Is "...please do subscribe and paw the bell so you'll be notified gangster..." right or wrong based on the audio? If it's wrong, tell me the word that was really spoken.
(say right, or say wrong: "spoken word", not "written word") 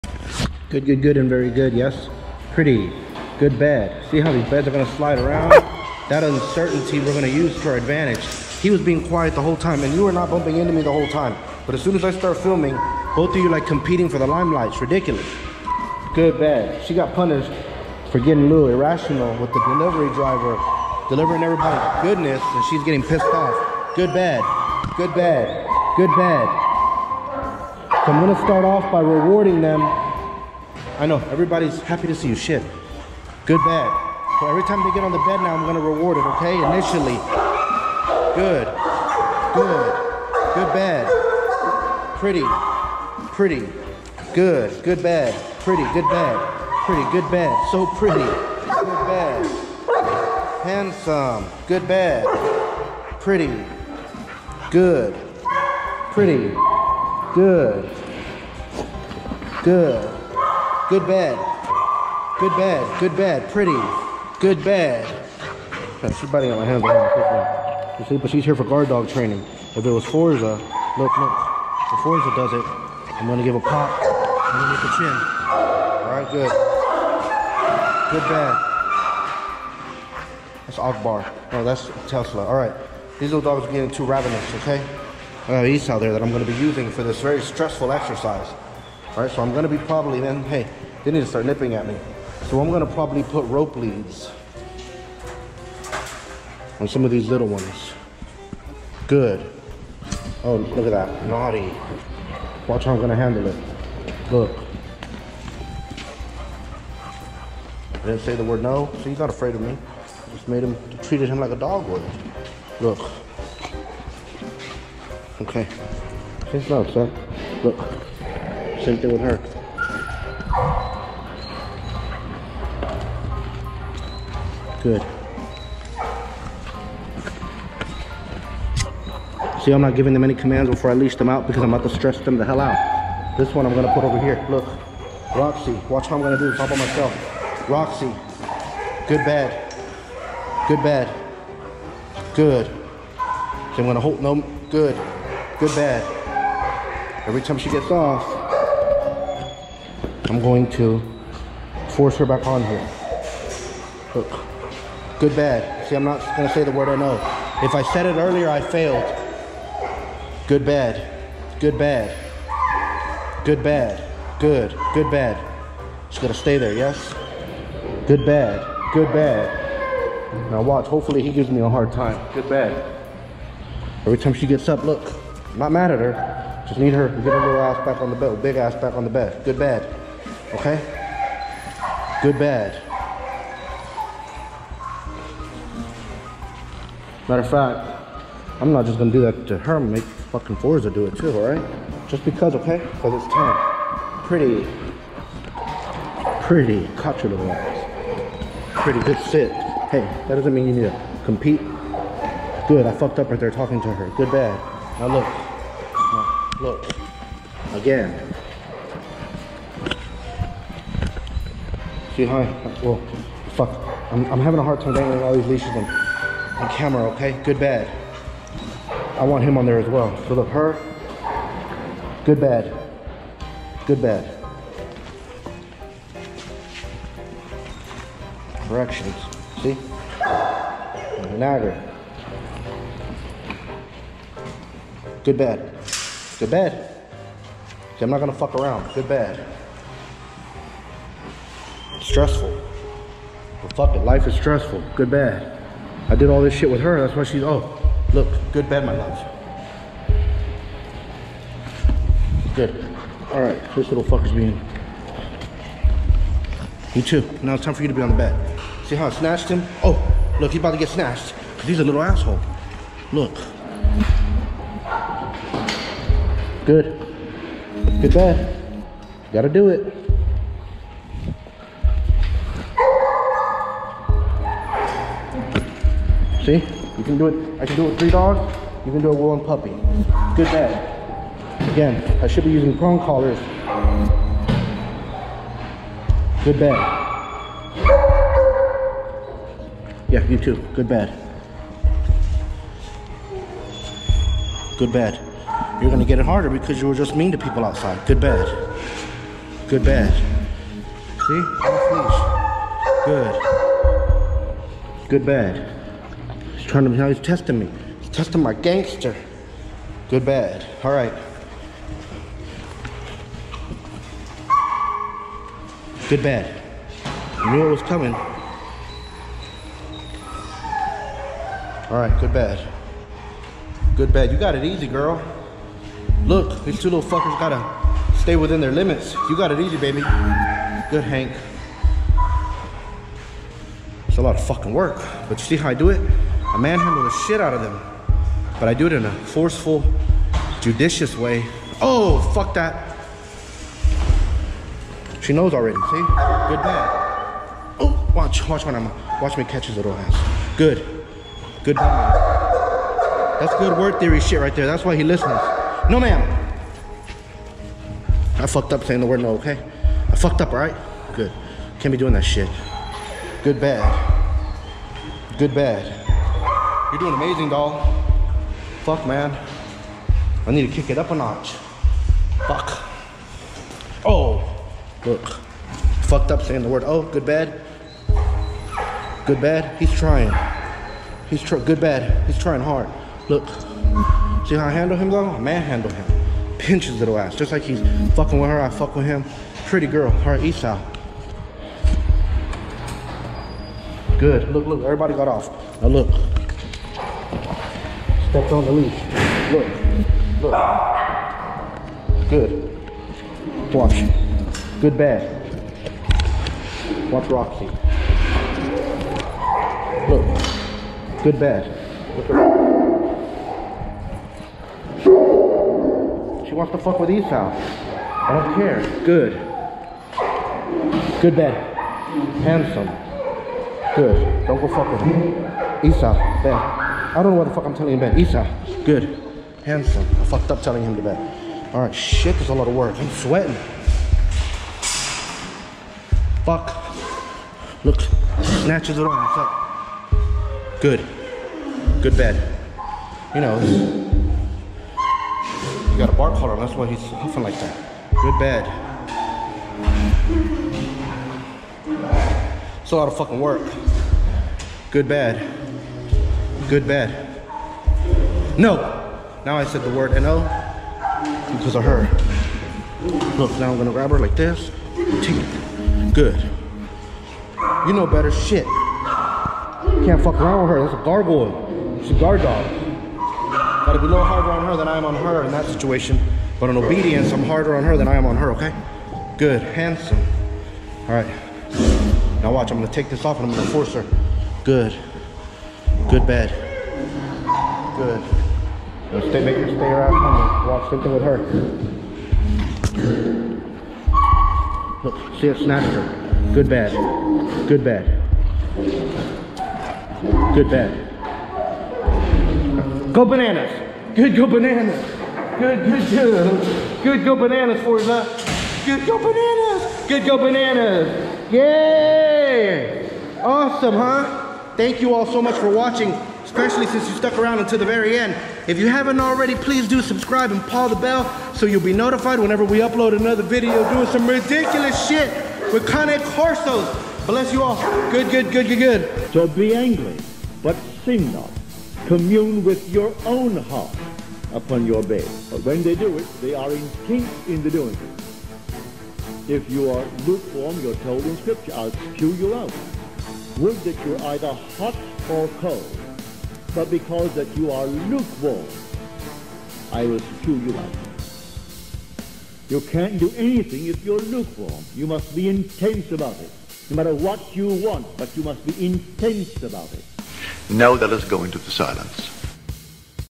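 wrong: "whenever", not "gangster".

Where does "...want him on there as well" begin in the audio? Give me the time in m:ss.
3:39.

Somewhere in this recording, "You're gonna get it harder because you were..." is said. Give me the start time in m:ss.
4:55.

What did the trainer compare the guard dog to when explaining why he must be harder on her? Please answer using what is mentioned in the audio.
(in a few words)
a gargoyle.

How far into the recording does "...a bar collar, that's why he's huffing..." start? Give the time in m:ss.
7:26.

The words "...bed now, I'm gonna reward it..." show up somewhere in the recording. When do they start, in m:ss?
0:35.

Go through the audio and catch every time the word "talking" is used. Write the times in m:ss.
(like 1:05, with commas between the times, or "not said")
3:23.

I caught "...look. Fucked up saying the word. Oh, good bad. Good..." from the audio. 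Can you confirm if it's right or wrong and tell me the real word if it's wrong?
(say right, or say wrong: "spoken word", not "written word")
right.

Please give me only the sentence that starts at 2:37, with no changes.
If I said it earlier, I failed.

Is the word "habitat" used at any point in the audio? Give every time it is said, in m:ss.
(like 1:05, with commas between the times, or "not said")
not said.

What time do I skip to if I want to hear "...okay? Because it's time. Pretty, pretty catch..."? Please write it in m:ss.
3:12.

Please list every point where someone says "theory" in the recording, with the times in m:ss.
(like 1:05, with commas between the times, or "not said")
5:54.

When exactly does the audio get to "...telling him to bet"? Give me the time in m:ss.
7:10.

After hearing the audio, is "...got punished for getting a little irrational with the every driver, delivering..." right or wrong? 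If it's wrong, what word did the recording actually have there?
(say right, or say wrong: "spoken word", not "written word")
wrong: "delivery", not "every".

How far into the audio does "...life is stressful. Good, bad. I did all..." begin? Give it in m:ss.
4:04.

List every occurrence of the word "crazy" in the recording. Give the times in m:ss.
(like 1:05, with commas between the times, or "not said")
not said.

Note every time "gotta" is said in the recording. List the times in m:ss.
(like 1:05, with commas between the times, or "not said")
4:29, 5:27, 7:53.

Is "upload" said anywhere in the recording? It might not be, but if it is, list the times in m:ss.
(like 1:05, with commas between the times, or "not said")
8:42.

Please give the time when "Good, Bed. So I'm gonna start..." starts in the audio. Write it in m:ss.
0:25.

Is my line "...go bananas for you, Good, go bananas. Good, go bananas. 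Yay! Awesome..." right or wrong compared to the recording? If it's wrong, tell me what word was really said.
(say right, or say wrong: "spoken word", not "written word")
right.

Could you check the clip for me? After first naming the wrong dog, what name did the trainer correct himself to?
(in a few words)
Tesla.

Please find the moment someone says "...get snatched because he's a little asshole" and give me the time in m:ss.
4:20.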